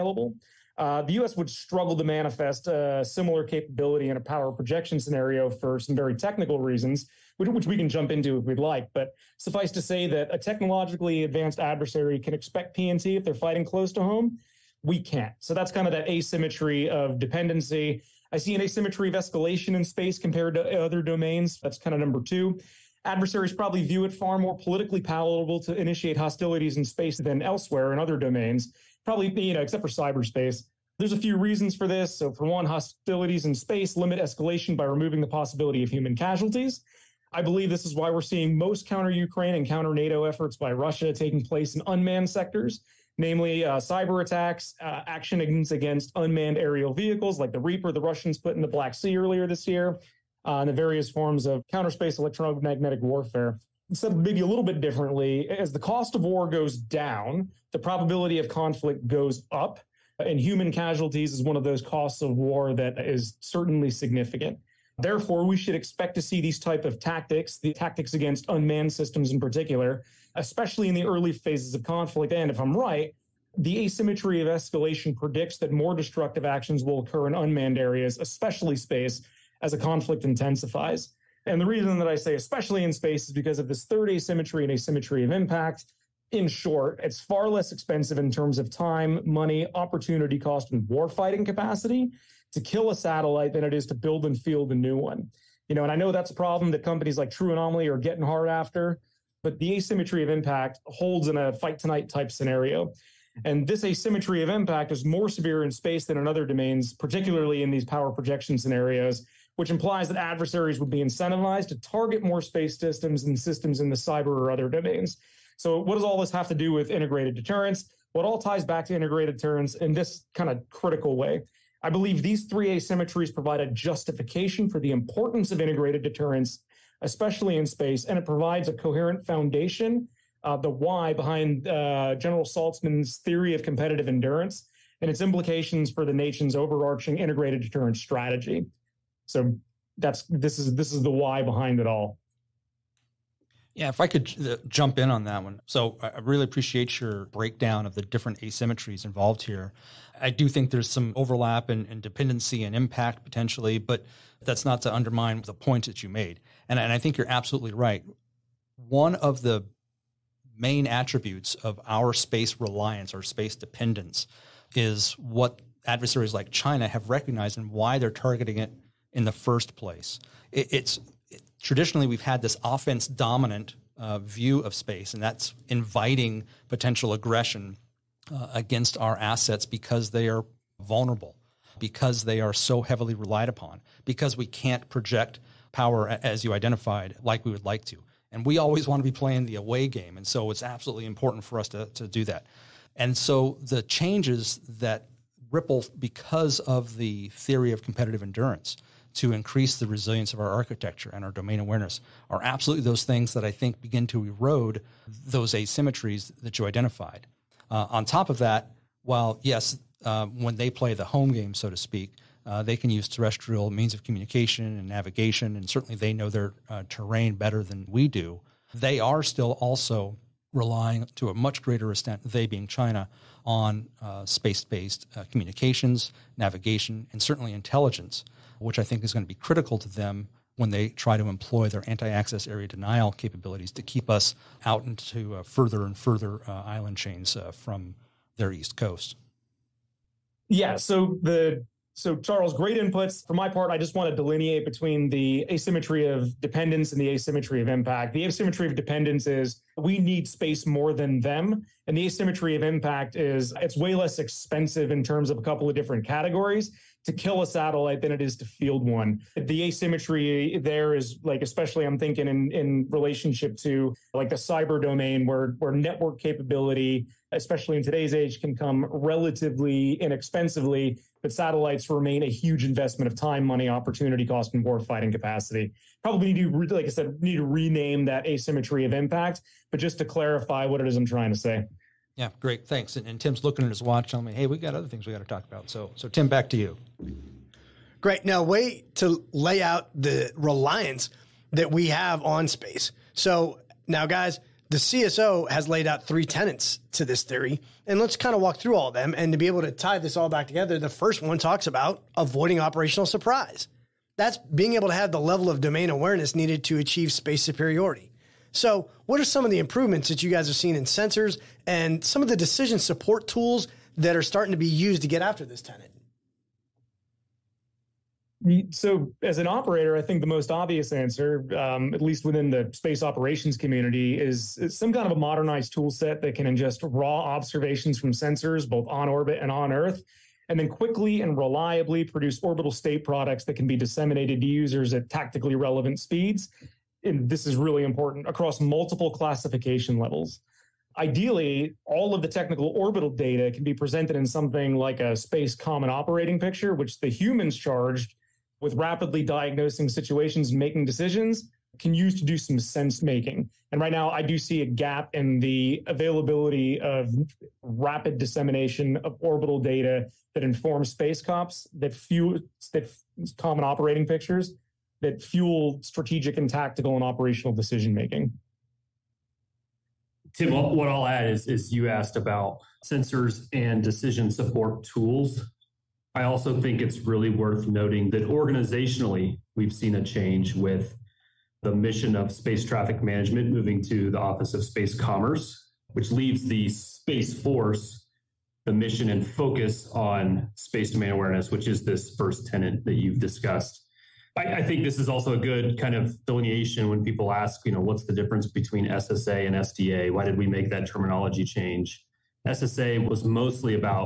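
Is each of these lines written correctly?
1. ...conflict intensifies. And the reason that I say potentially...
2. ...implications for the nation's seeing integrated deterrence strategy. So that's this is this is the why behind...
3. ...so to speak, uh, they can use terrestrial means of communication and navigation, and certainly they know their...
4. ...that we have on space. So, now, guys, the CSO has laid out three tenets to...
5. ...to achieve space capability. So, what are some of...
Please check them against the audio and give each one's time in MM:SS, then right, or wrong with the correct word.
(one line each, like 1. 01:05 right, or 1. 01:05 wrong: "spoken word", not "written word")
1. 01:19 wrong: "especially", not "potentially"
2. 02:15 wrong: "overarching", not "seeing"
3. 03:31 right
4. 04:51 right
5. 05:06 wrong: "superiority", not "capability".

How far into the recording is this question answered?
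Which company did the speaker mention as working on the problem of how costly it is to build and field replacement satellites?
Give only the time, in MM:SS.
01:37.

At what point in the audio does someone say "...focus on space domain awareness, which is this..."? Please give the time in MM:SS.
06:29.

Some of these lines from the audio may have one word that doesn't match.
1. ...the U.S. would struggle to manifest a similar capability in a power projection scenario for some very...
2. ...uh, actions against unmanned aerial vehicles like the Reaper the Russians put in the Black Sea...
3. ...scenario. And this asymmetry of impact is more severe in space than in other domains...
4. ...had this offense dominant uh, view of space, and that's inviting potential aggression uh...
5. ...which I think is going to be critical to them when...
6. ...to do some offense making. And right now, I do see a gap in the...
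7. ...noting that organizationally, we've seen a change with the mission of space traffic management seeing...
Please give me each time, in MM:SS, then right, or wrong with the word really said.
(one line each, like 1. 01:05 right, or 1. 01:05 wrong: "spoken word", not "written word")
1. 00:01 right
2. 00:44 right
3. 01:42 right
4. 02:52 right
5. 03:48 right
6. 05:52 wrong: "sense", not "offense"
7. 06:17 wrong: "moving", not "seeing".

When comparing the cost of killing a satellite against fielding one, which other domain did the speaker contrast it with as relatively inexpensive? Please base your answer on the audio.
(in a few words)
cyber domain.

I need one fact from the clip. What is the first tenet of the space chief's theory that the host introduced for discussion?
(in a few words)
avoiding operational surprise.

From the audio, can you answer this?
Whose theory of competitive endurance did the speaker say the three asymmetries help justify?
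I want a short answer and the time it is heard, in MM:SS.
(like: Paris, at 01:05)
General Saltzman, at 02:12.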